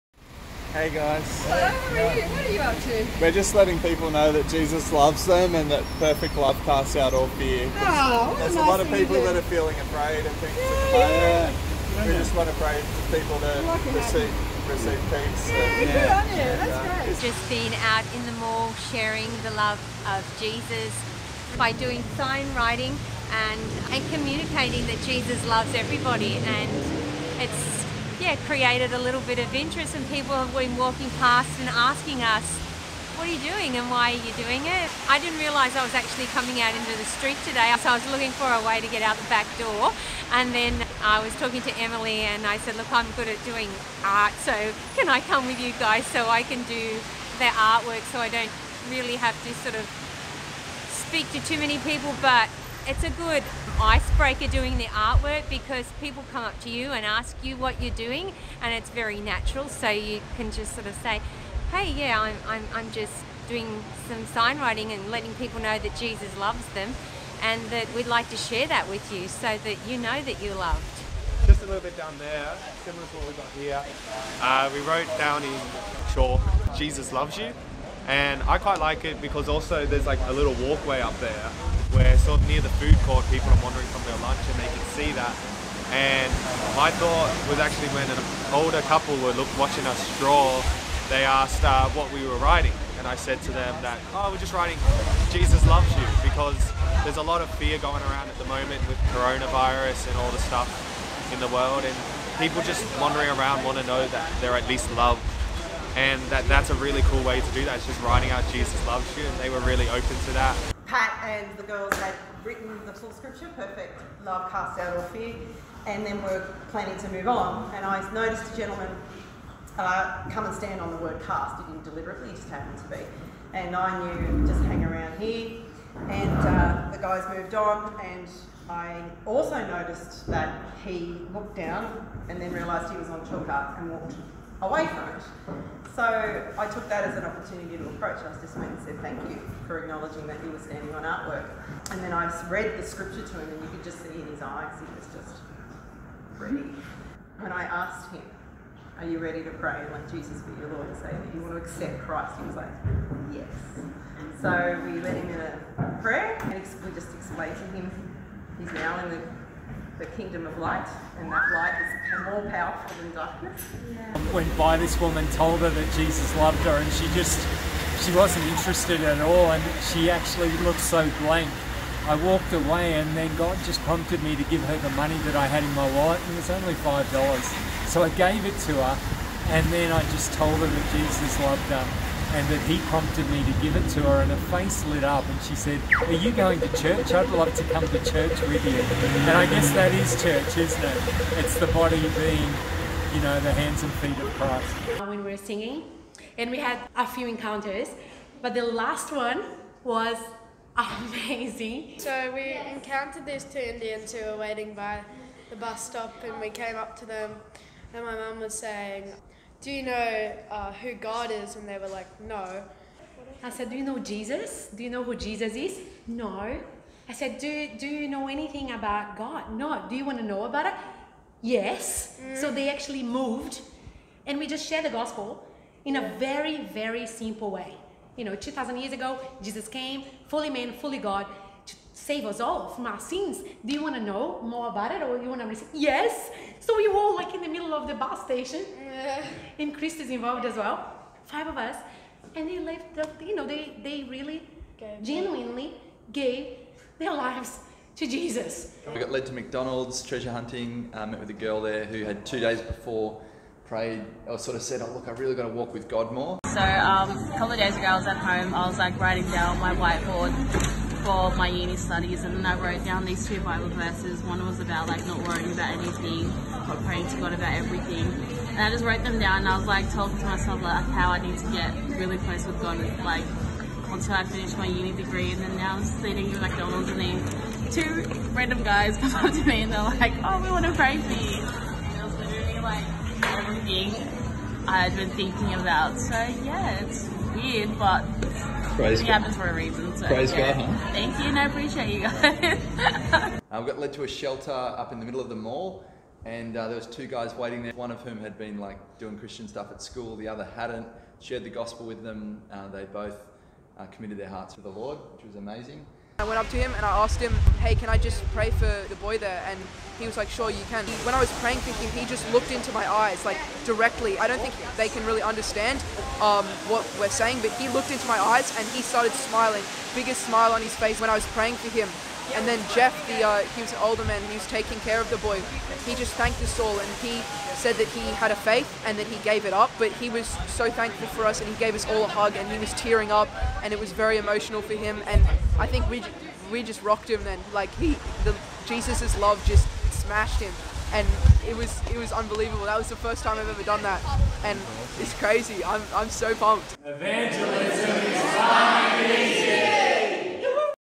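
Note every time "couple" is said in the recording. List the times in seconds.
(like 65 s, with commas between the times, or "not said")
88 s, 257 s.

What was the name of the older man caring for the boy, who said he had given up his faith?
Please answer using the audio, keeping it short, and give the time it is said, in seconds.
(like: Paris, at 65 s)
Jeff, at 322 s.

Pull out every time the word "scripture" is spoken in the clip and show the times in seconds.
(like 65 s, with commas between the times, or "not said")
113 s, 142 s.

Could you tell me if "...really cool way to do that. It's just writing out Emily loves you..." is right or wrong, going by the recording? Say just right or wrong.
wrong.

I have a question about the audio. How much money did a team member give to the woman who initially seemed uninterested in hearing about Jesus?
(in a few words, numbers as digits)
$5.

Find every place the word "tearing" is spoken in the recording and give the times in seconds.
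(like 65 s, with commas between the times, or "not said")
332 s.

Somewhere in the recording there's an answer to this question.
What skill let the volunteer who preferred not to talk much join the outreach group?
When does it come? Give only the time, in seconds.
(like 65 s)
42 s.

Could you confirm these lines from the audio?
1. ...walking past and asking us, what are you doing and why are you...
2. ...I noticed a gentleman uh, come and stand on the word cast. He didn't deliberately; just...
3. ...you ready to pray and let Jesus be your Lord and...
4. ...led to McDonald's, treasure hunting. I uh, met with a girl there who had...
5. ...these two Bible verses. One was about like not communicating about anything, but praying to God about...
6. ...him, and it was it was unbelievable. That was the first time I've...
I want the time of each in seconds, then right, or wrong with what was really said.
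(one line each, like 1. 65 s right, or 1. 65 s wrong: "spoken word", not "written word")
1. 30 s right
2. 117 s right
3. 149 s right
4. 249 s right
5. 263 s wrong: "worrying", not "communicating"
6. 340 s right.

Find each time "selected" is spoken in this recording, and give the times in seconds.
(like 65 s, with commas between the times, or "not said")
not said.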